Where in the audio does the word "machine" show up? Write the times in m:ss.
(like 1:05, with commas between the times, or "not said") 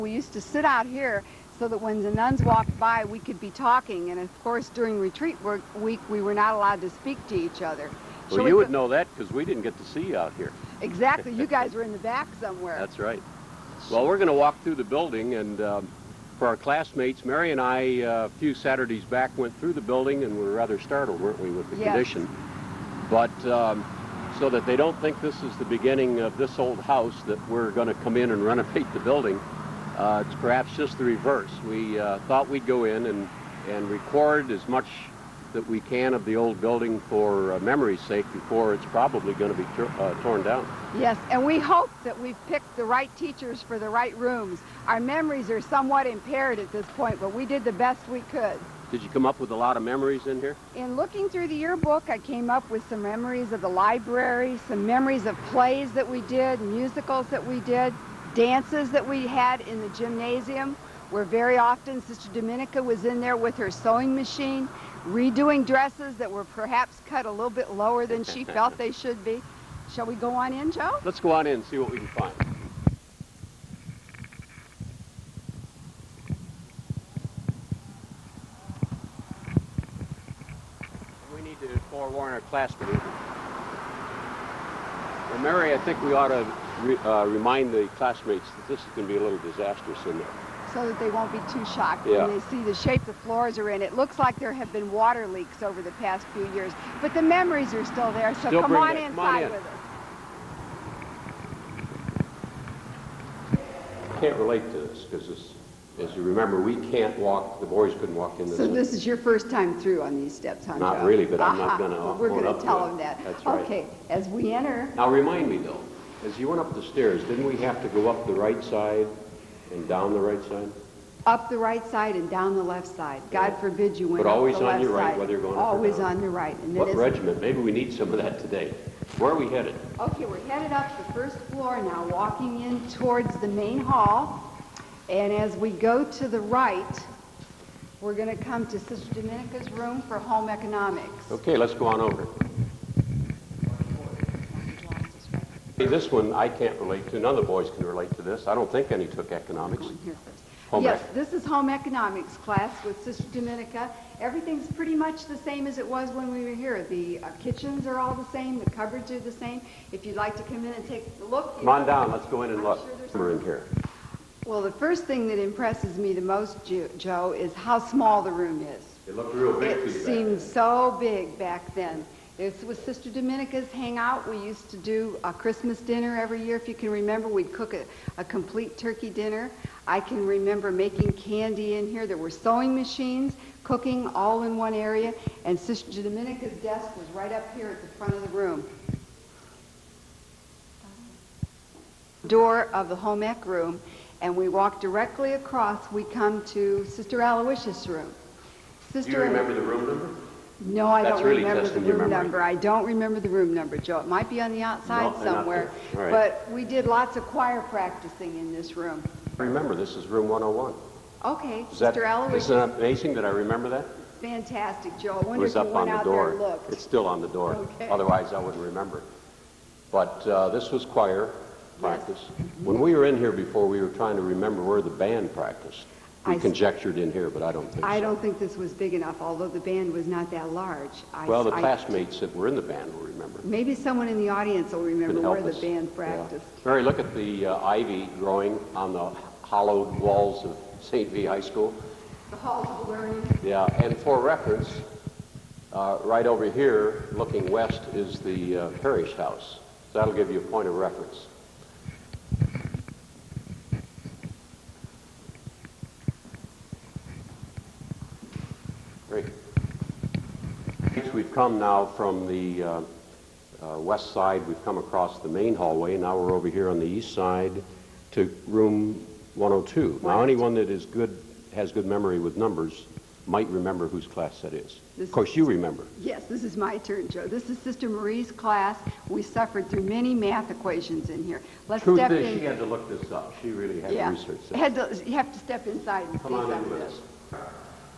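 1:04, 3:02.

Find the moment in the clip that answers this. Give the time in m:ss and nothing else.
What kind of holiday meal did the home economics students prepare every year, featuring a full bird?
2:55.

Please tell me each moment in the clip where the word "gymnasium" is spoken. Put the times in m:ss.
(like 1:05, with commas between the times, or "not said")
0:59.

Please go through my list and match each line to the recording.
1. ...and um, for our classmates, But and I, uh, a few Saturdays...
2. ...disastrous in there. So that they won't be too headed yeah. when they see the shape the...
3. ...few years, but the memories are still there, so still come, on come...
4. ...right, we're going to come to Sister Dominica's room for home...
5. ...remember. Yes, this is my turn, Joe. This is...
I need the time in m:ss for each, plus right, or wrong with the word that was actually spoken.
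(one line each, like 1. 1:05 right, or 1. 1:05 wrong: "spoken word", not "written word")
1. 0:15 wrong: "Mary", not "But"
2. 1:29 wrong: "shocked", not "headed"
3. 1:36 right
4. 2:16 right
5. 4:35 right.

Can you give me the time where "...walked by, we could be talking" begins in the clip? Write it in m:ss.
0:02.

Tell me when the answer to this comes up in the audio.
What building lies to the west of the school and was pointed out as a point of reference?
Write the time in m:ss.
4:08.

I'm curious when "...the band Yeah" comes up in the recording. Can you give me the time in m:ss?
3:55.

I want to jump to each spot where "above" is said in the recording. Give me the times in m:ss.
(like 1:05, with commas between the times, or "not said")
not said.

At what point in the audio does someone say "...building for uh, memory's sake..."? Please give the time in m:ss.
0:36.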